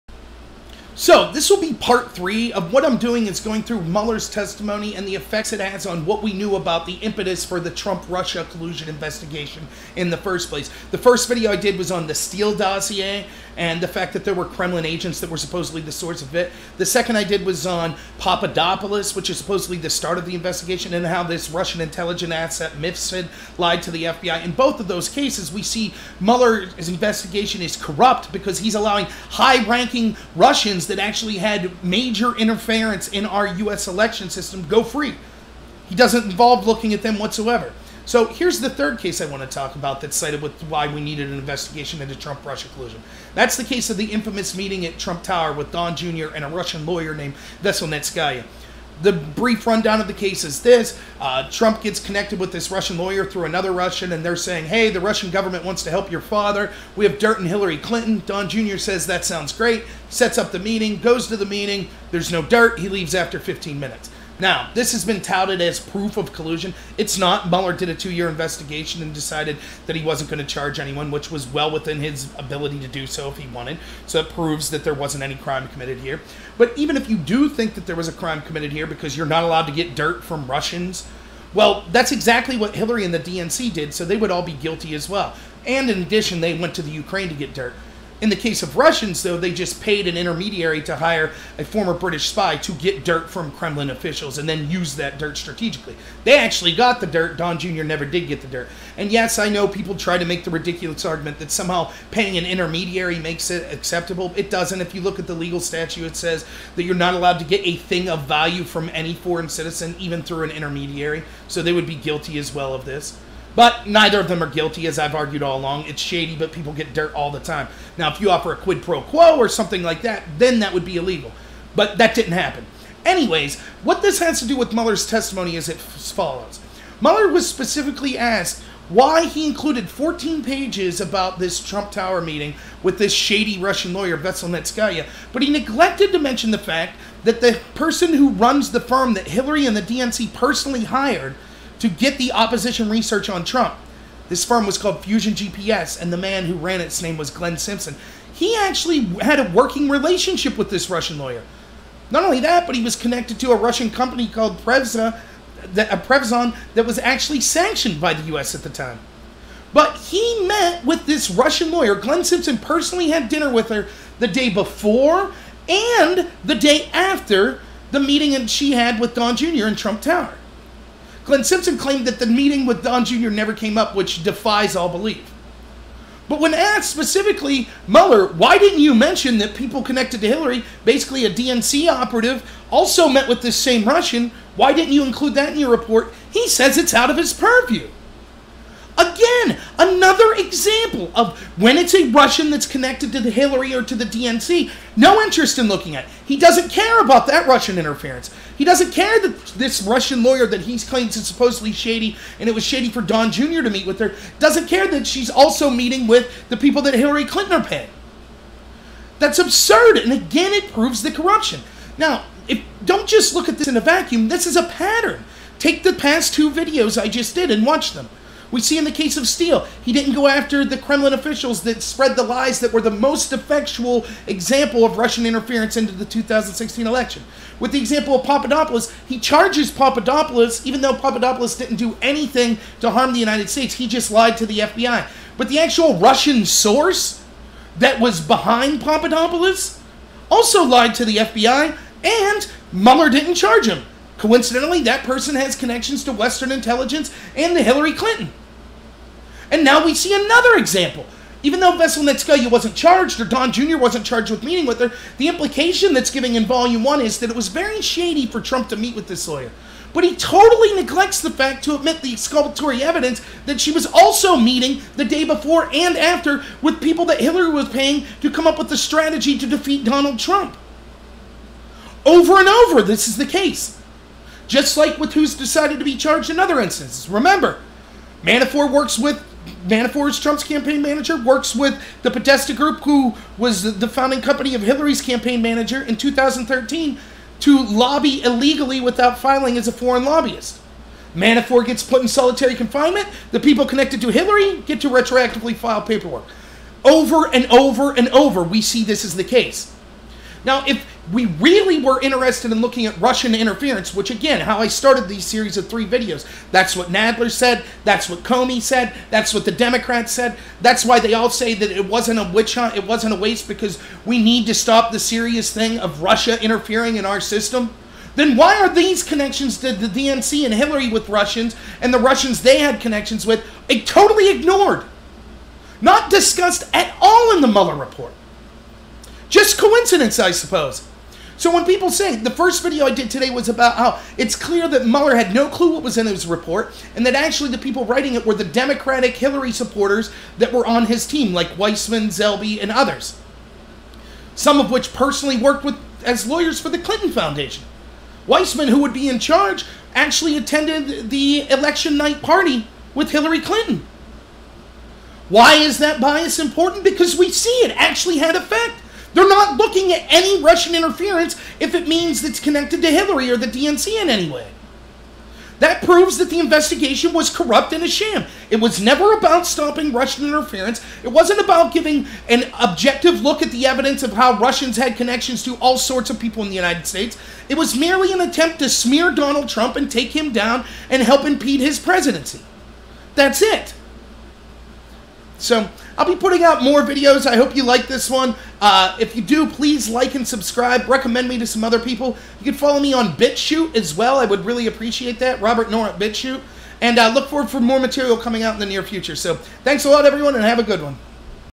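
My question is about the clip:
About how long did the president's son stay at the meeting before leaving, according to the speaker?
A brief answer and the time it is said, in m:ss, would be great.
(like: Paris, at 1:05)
15 minutes, at 1:03.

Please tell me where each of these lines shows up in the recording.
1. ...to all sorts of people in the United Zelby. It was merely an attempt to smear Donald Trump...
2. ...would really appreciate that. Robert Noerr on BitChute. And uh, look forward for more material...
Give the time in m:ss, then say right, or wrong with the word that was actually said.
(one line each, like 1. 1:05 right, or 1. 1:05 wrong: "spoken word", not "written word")
1. 6:15 wrong: "States", not "Zelby"
2. 6:34 right.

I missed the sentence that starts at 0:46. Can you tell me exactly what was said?
and a Russian lawyer named Veselnitskaya.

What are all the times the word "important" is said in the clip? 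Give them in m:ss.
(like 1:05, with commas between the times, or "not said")
5:56.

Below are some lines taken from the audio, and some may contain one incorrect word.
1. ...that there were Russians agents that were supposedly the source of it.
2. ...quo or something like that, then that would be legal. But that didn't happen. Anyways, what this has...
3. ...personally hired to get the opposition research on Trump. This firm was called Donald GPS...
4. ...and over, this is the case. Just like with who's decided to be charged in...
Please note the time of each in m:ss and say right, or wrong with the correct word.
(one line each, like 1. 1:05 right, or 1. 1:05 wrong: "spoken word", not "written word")
1. 0:14 wrong: "Kremlin", not "Russians"
2. 1:59 wrong: "illegal", not "legal"
3. 2:20 wrong: "Fusion", not "Donald"
4. 4:32 right.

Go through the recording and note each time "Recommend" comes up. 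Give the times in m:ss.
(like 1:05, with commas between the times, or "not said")
6:30.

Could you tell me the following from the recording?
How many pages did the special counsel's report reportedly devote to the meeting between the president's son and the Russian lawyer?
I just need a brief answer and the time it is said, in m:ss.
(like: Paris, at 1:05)
14, at 2:09.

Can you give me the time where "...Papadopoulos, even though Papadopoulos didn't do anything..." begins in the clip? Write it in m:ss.
3:49.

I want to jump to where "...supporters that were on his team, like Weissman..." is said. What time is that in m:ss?
5:39.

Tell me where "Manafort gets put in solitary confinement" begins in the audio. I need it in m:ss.
4:51.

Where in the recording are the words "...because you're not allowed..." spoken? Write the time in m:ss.
1:18.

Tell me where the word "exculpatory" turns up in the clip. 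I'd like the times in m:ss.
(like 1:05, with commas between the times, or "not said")
4:22.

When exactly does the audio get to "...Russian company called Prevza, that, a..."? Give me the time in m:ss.
2:33.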